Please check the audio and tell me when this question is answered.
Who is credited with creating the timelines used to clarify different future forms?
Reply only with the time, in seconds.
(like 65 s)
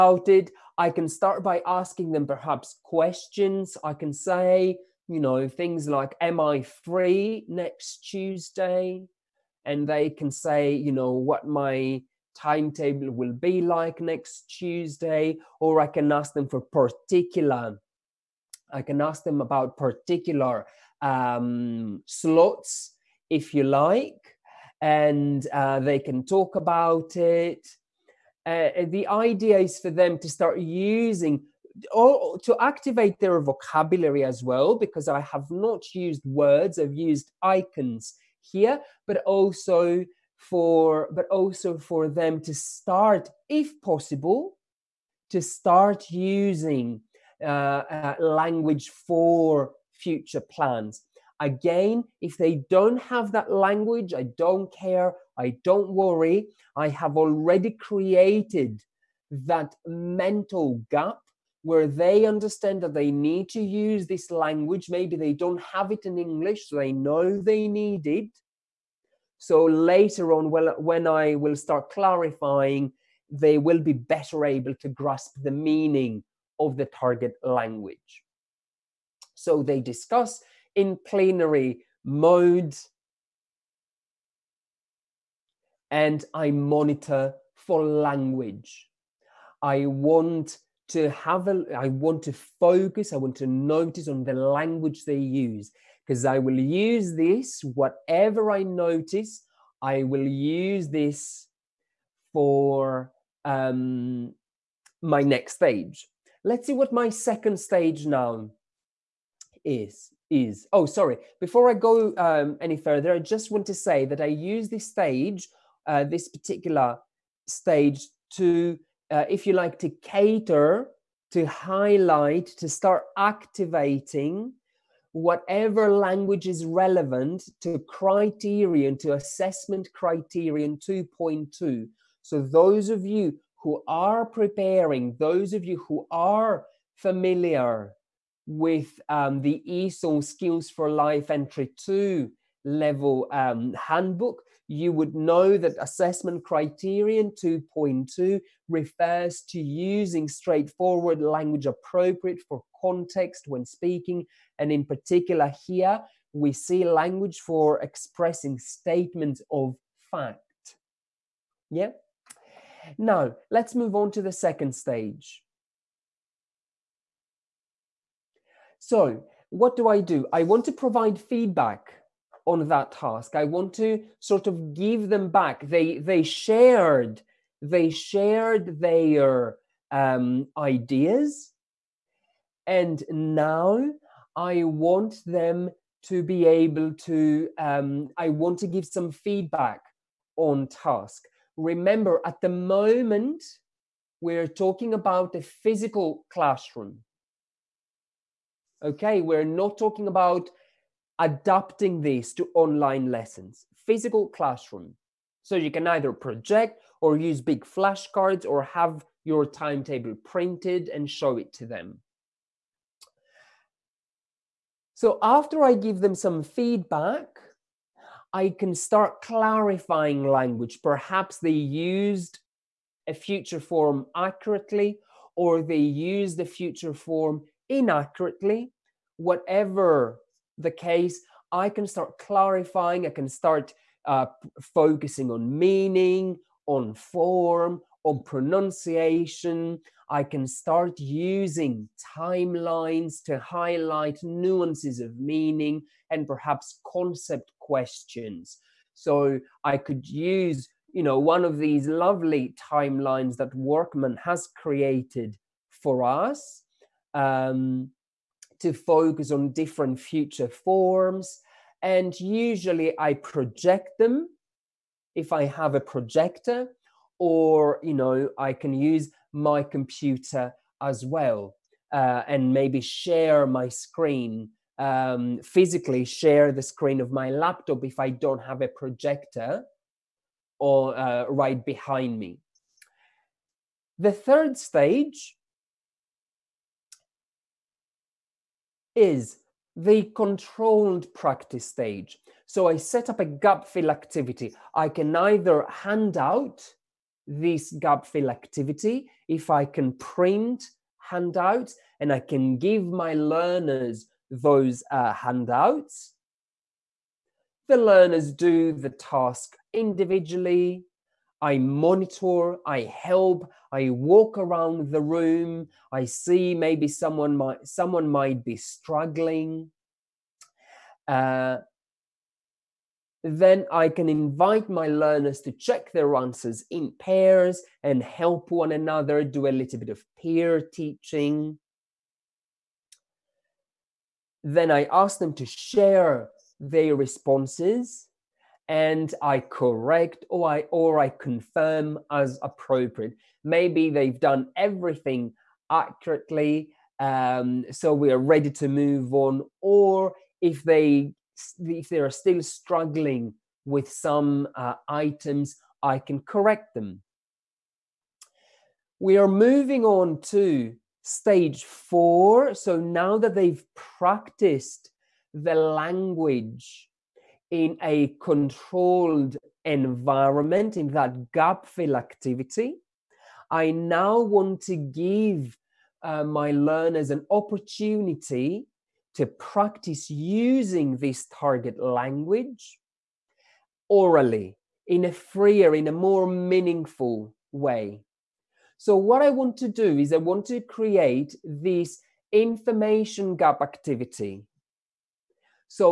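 253 s.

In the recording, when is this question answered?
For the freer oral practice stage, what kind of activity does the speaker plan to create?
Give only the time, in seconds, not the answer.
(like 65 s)
392 s.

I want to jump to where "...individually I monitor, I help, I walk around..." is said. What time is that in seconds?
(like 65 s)
309 s.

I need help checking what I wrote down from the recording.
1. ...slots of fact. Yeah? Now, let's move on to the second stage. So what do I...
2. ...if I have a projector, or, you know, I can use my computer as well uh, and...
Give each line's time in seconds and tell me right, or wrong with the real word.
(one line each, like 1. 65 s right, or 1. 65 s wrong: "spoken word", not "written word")
1. 158 s wrong: "statements", not "slots"
2. 265 s right.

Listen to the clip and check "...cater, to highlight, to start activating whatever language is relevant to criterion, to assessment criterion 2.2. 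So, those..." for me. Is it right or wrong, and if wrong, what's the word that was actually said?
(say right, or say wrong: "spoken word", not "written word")
right.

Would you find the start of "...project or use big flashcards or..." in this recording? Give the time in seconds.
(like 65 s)
206 s.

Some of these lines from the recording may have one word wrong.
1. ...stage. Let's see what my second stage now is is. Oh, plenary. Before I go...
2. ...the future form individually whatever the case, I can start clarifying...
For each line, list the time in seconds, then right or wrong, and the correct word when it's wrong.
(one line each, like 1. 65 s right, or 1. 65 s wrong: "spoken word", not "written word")
1. 105 s wrong: "sorry", not "plenary"
2. 226 s wrong: "inaccurately", not "individually".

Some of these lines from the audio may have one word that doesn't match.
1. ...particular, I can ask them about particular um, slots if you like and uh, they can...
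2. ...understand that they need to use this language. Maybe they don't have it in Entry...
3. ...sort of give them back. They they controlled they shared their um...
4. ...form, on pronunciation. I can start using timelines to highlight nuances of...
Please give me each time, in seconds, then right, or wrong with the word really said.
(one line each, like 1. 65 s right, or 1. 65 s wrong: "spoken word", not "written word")
1. 16 s right
2. 62 s wrong: "English", not "Entry"
3. 174 s wrong: "shared", not "controlled"
4. 236 s right.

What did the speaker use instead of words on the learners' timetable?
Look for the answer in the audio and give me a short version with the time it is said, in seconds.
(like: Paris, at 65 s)
Icons, at 37 s.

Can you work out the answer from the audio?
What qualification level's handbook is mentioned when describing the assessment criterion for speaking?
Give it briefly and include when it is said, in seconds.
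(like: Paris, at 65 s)
Entry 2, at 141 s.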